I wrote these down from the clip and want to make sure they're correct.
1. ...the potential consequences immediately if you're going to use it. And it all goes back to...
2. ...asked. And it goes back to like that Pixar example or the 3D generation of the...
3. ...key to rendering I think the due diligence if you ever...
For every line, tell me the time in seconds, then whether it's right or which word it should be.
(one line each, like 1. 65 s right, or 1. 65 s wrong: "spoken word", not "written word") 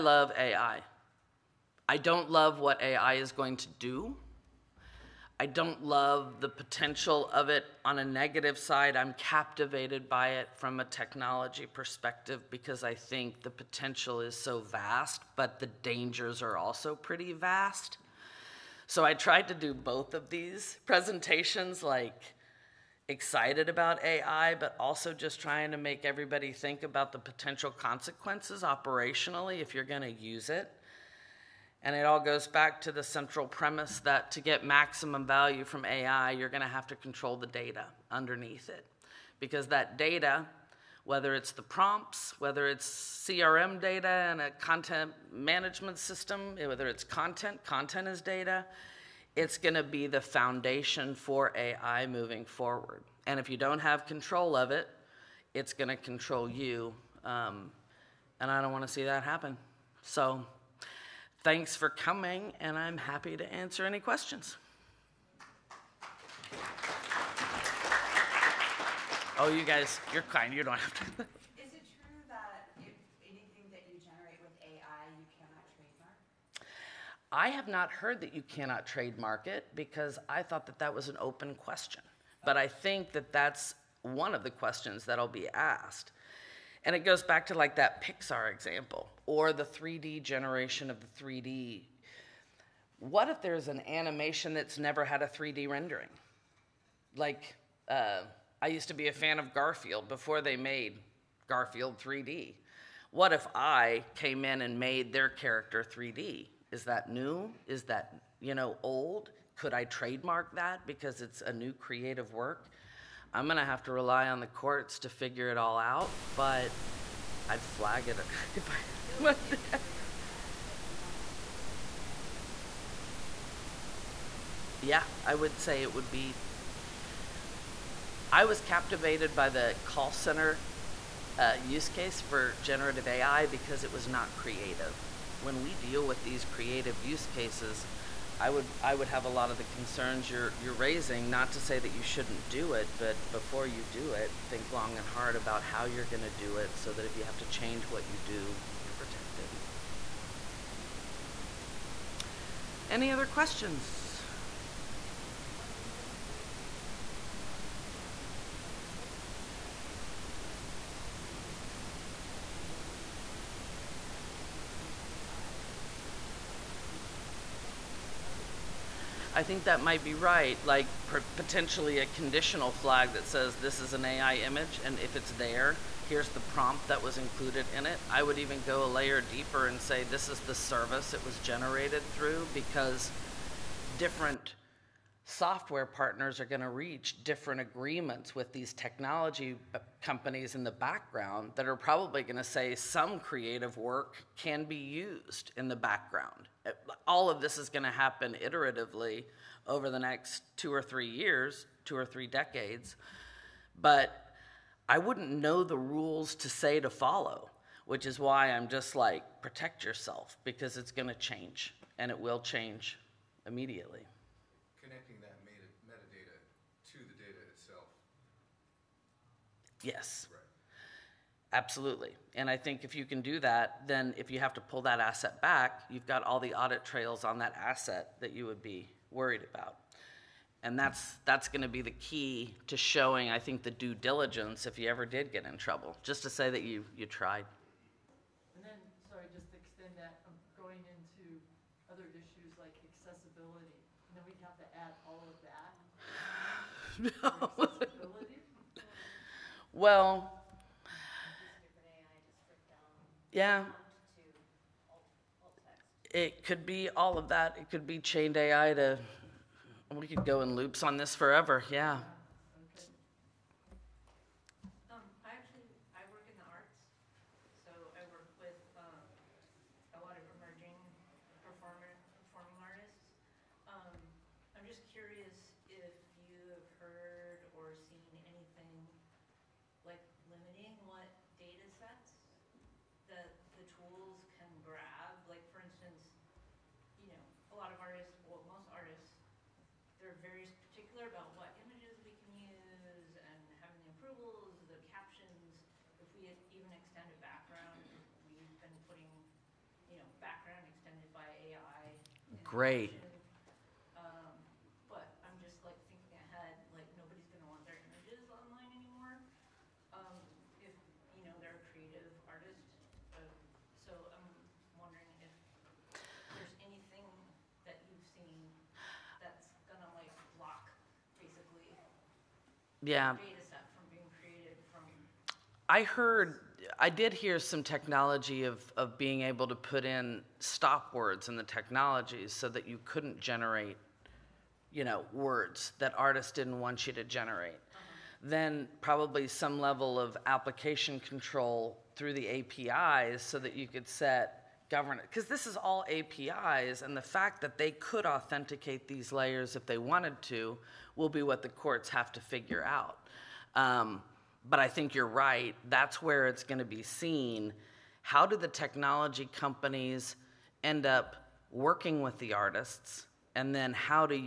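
1. 27 s wrong: "operationally", not "immediately"
2. 85 s right
3. 231 s wrong: "showing", not "rendering".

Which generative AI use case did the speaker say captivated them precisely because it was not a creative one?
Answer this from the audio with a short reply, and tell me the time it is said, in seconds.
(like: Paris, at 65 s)
Call center, at 129 s.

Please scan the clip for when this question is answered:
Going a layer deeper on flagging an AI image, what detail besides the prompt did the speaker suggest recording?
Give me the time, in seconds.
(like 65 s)
180 s.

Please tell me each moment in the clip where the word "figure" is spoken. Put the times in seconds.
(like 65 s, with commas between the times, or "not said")
115 s, 352 s.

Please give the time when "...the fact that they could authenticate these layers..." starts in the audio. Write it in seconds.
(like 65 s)
346 s.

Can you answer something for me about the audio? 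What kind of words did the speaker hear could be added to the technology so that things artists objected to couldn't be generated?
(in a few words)
Stop words.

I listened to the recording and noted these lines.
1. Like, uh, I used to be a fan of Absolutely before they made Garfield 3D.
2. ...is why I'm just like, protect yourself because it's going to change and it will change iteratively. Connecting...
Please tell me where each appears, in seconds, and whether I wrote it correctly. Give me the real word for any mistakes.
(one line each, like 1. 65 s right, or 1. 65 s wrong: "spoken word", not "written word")
1. 97 s wrong: "Garfield", not "Absolutely"
2. 208 s wrong: "immediately", not "iteratively".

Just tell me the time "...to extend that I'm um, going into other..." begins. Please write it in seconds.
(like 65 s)
239 s.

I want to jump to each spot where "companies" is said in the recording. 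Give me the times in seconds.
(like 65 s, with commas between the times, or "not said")
190 s, 359 s.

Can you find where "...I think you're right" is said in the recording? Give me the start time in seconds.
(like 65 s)
354 s.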